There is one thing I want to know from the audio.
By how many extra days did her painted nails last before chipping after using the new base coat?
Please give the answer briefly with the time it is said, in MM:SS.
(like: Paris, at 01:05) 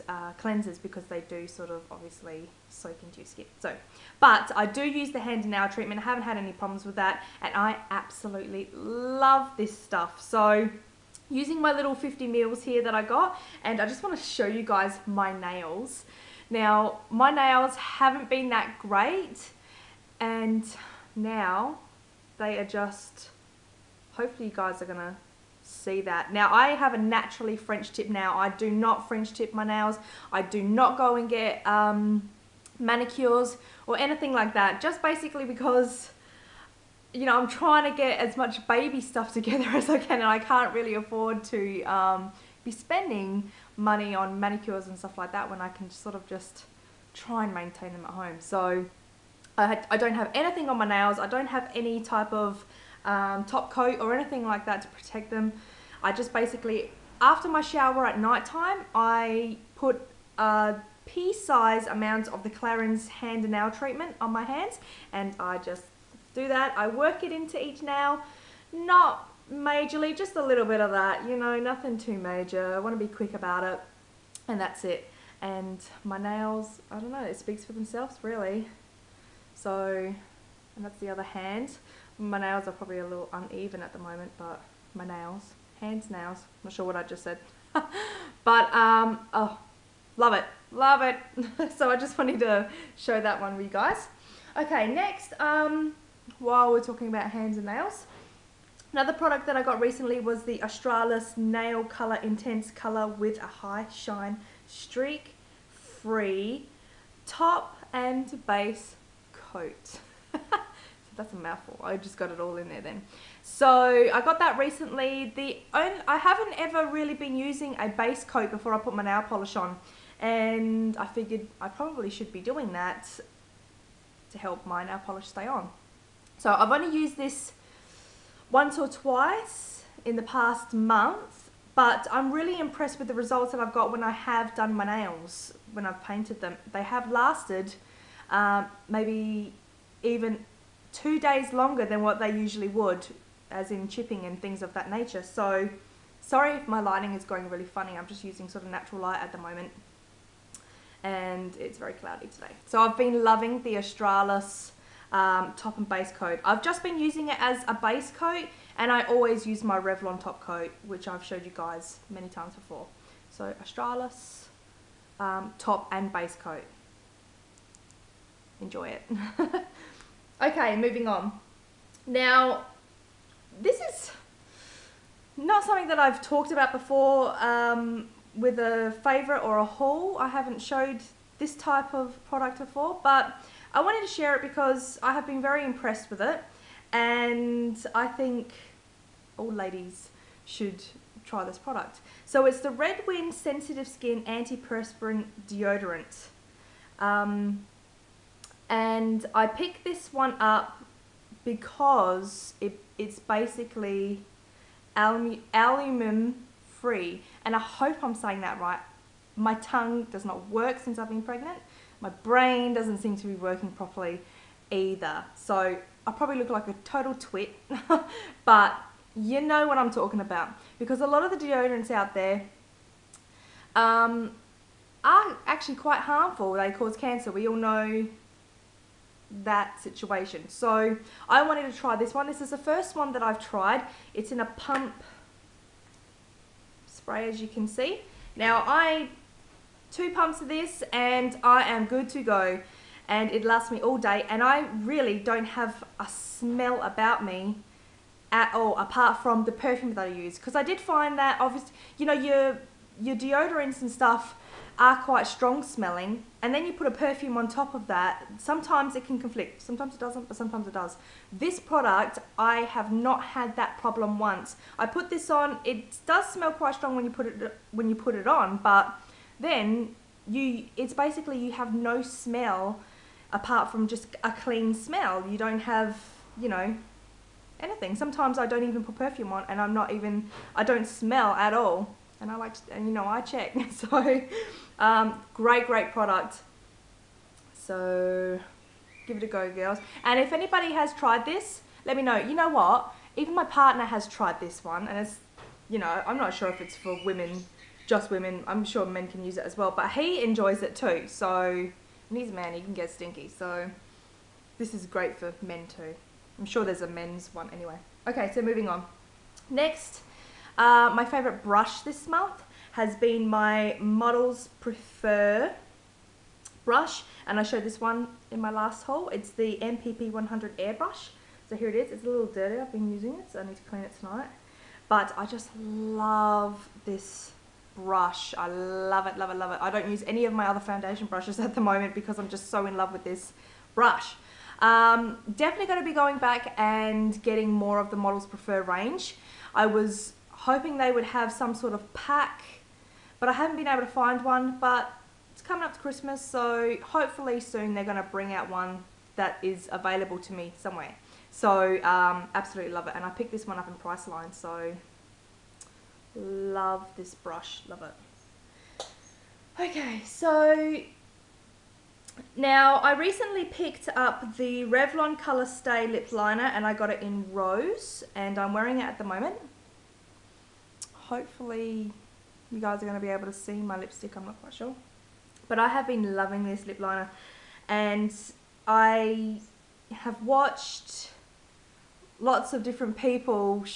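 2, at 02:20.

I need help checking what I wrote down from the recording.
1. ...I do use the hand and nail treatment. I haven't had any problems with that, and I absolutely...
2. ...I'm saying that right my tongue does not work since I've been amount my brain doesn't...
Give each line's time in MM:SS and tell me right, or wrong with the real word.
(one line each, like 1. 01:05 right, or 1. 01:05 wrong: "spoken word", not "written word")
1. 00:04 right
2. 03:28 wrong: "pregnant", not "amount".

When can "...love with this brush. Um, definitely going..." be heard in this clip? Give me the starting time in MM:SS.
05:32.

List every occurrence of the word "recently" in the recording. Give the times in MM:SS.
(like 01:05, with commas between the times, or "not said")
01:39, 01:54, 06:02.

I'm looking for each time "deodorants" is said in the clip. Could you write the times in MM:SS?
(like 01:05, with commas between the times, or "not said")
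03:15, 03:41, 04:13.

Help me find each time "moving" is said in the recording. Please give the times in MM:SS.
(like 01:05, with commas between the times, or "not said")
02:50, 05:08.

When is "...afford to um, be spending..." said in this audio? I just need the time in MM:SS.
00:40.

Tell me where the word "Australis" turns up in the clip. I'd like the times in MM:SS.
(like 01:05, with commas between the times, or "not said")
01:40, 02:33, 02:43.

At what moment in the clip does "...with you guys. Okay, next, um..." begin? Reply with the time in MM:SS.
01:33.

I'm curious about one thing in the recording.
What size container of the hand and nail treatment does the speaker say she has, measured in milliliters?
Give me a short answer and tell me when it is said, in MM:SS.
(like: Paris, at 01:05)
50 mils, at 00:11.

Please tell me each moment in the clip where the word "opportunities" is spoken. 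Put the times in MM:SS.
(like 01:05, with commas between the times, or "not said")
not said.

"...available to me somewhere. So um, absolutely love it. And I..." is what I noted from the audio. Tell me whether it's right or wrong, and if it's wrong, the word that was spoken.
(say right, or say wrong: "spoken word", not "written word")
right.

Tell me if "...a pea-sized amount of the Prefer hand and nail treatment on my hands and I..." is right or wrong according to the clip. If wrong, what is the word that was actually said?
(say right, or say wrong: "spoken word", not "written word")
wrong: "Clarins", not "Prefer".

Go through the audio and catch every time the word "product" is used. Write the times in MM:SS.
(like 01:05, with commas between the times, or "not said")
01:39, 03:02, 03:11, 04:21, 04:45.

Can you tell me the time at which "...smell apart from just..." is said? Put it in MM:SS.
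04:32.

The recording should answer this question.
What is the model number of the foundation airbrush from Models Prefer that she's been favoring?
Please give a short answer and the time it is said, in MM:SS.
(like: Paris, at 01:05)
MPP 100, at 05:19.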